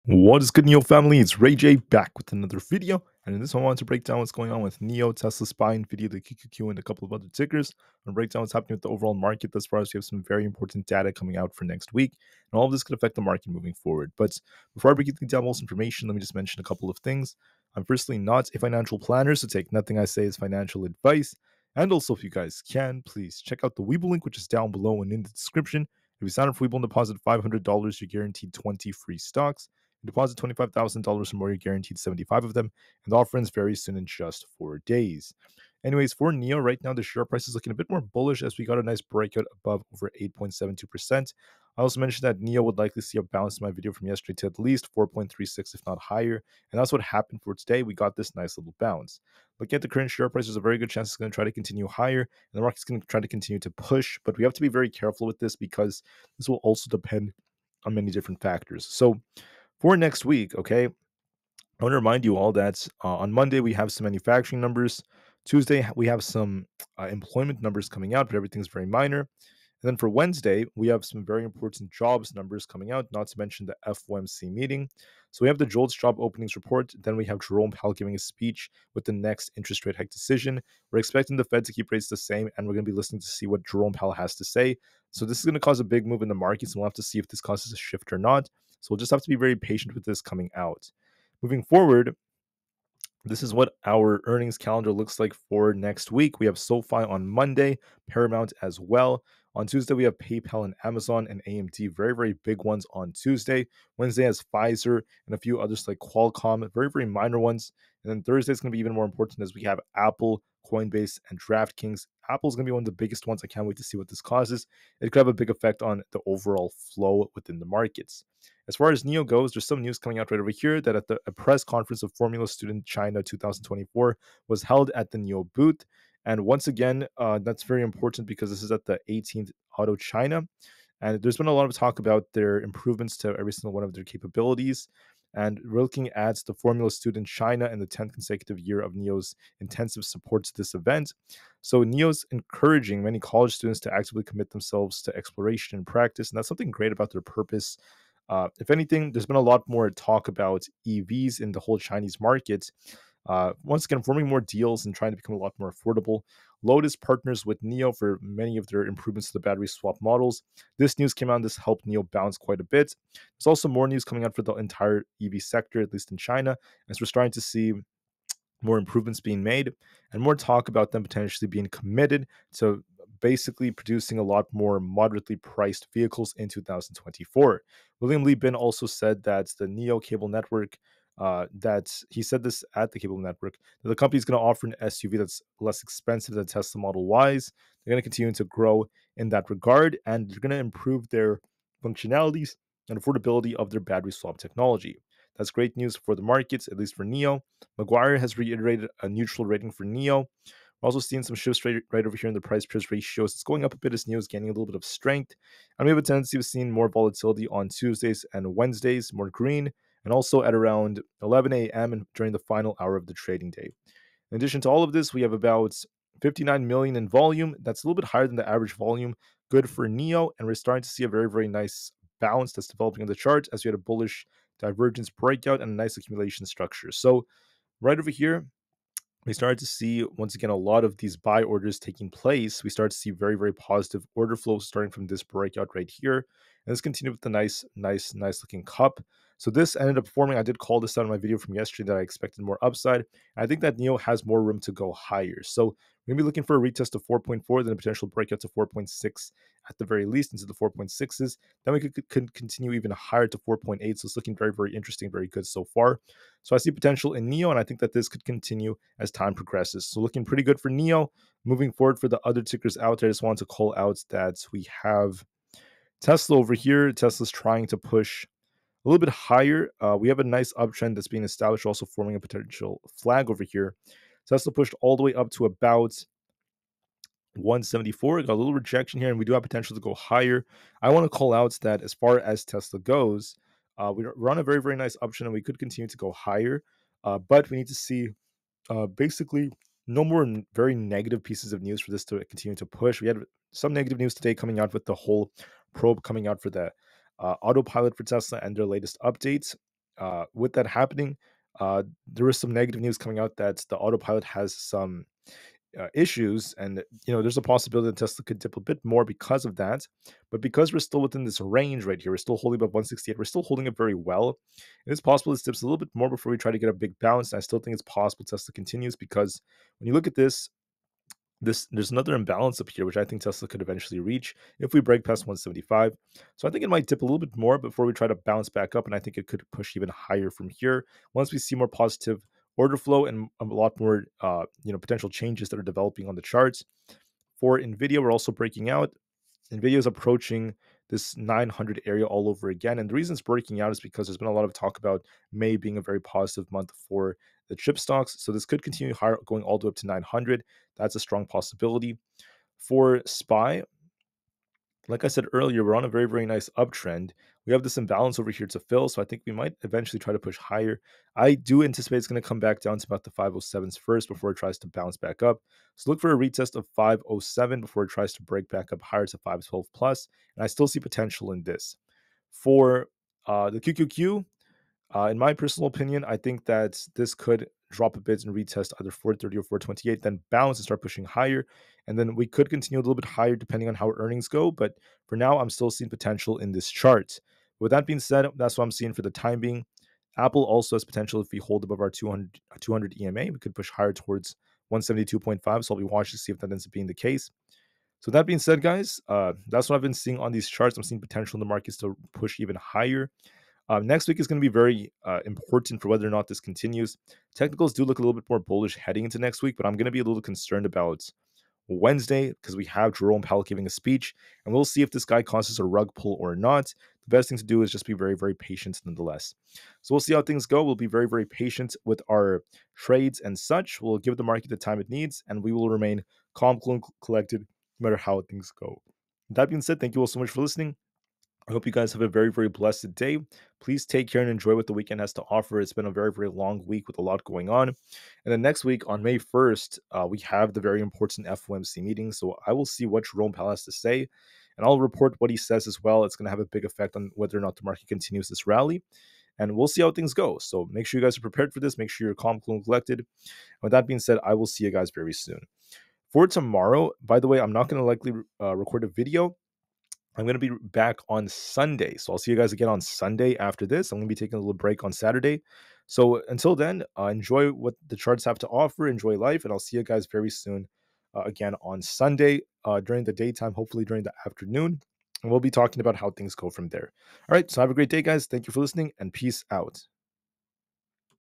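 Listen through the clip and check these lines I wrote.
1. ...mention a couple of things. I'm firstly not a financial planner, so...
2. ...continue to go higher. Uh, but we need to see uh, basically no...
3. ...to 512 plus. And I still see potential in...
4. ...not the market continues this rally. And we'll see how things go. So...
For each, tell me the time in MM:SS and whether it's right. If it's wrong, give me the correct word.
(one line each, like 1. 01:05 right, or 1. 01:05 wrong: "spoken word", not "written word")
1. 00:16 right
2. 04:45 right
3. 06:09 right
4. 07:27 right.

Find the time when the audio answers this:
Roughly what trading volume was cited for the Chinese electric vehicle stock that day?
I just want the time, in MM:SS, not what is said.
03:36.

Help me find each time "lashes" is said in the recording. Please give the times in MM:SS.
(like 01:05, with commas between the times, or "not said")
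not said.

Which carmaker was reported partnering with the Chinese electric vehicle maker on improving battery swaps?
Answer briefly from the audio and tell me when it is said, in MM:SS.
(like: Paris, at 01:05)
Lotus, at 02:36.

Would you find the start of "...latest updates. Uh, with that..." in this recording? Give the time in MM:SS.
04:58.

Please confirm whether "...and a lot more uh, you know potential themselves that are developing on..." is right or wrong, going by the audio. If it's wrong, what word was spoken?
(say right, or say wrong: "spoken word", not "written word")
wrong: "changes", not "themselves".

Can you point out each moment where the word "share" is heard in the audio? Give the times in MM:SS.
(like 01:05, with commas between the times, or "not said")
00:37, 00:50.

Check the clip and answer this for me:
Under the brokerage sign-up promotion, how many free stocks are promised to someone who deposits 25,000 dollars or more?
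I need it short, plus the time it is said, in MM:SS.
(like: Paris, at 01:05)
75, at 00:31.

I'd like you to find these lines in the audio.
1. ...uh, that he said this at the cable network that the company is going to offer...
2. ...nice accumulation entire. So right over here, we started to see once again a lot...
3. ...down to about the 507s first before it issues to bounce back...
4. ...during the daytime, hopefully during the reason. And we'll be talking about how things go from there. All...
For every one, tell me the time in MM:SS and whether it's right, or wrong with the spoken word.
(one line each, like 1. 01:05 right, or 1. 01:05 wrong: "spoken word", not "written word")
1. 03:01 right
2. 03:45 wrong: "structure", not "entire"
3. 06:02 wrong: "tries", not "issues"
4. 07:52 wrong: "afternoon", not "reason".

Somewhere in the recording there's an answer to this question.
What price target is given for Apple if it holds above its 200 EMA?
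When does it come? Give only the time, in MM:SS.
06:34.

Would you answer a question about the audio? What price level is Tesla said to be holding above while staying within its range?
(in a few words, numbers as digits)
168.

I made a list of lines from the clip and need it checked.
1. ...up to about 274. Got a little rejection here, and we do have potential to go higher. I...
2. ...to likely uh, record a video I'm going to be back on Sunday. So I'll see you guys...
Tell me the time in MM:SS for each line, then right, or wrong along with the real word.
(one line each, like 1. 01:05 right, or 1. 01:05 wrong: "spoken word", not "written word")
1. 04:35 wrong: "174", not "274"
2. 07:37 right.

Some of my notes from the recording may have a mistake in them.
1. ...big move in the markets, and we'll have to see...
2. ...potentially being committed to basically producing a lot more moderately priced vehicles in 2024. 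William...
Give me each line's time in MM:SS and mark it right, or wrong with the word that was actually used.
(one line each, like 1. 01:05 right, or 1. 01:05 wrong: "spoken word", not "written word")
1. 01:25 right
2. 02:51 right.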